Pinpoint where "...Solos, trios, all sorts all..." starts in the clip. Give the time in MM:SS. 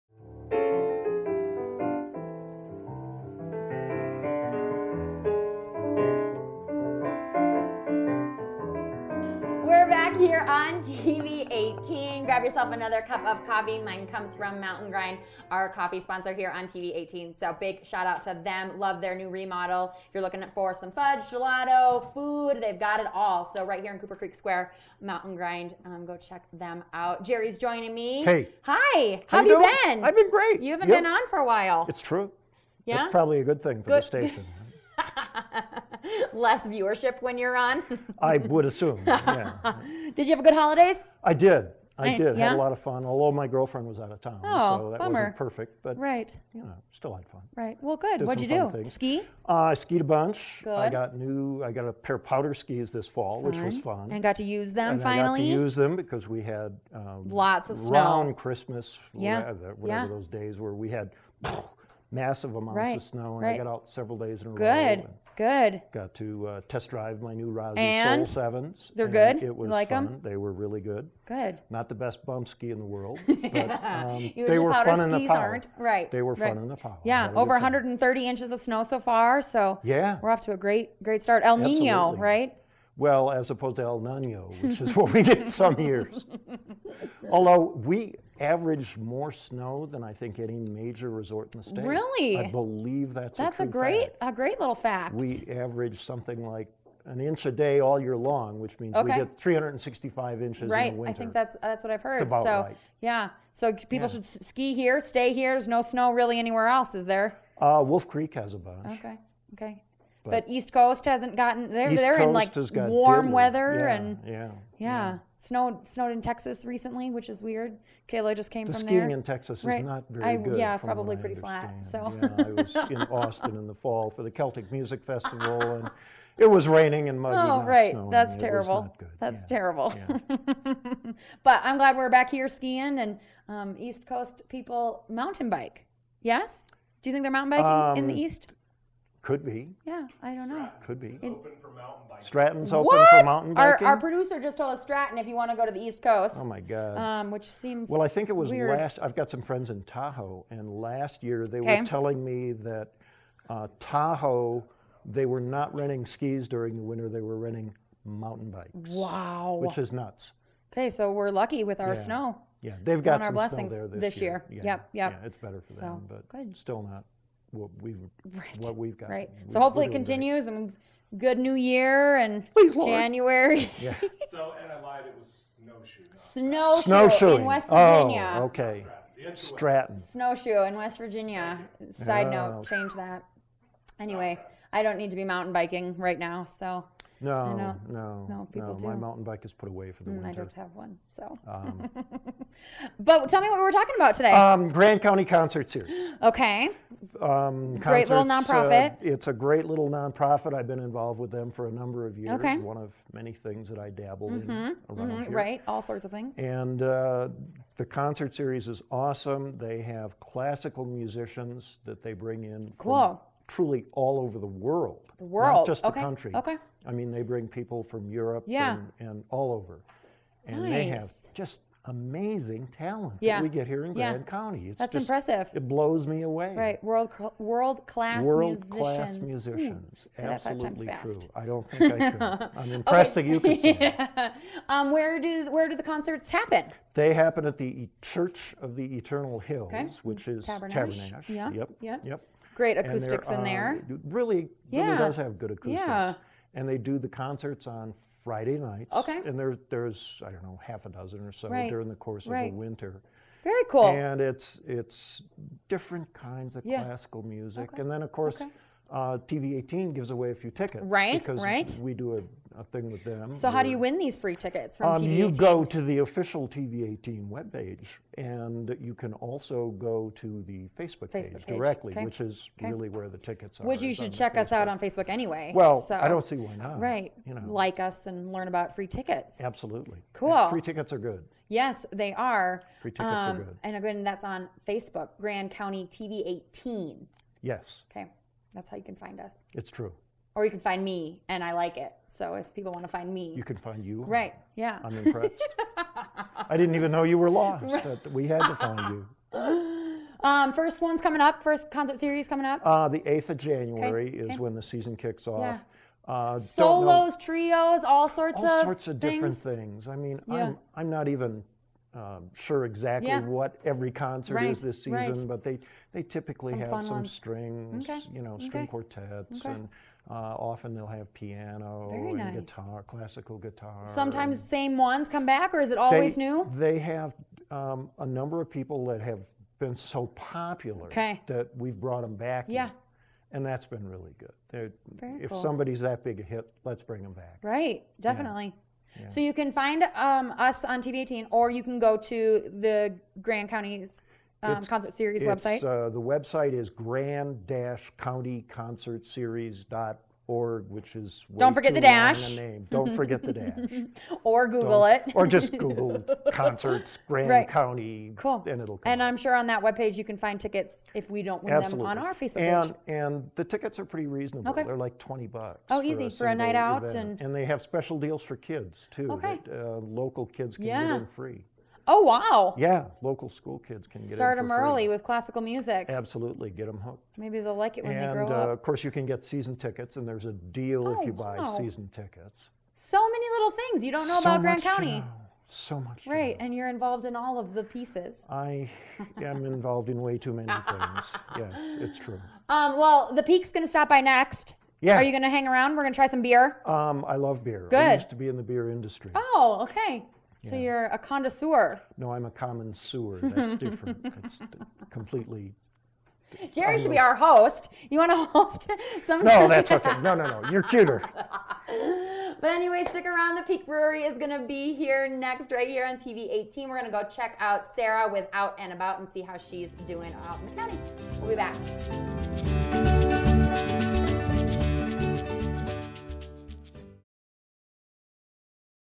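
05:06.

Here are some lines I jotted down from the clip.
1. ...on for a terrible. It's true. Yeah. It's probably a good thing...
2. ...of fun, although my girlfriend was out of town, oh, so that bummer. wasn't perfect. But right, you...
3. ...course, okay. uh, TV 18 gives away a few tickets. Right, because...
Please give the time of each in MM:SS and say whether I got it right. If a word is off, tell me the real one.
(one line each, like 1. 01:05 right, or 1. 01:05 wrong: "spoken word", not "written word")
1. 00:31 wrong: "while", not "terrible"
2. 00:42 right
3. 04:18 right.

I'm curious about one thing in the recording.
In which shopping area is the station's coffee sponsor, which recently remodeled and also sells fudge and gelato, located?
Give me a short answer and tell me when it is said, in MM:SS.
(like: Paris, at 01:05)
Cooper Creek Square, at 00:23.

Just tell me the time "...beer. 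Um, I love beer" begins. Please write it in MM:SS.
06:36.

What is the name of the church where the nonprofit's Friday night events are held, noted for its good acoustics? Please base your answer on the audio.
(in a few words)
Church of the Eternal Hills.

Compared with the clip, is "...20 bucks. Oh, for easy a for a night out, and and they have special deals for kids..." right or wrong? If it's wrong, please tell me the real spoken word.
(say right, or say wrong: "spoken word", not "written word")
right.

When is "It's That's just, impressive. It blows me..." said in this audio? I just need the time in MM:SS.
03:44.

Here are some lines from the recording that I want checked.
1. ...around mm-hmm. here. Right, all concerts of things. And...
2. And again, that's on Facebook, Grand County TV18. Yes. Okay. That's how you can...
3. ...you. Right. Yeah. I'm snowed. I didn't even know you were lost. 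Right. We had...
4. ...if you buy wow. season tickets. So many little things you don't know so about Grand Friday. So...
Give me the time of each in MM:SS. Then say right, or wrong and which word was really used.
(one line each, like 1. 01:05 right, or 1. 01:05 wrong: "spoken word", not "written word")
1. 03:24 wrong: "sorts", not "concerts"
2. 04:43 right
3. 04:53 wrong: "impressed", not "snowed"
4. 06:20 wrong: "County", not "Friday".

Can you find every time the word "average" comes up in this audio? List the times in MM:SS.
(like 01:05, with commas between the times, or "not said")
01:28, 01:35.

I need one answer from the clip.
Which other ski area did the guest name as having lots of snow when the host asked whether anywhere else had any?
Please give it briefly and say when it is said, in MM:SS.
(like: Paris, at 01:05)
Wolf Creek, at 01:47.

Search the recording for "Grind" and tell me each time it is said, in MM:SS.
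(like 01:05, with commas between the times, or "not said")
00:14, 00:25.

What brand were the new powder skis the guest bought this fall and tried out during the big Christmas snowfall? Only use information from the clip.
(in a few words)
Rossignol.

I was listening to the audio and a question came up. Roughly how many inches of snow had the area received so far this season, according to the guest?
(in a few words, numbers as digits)
130.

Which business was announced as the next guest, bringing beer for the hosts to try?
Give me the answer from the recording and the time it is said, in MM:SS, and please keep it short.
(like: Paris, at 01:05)
The Peak Brewery, at 06:53.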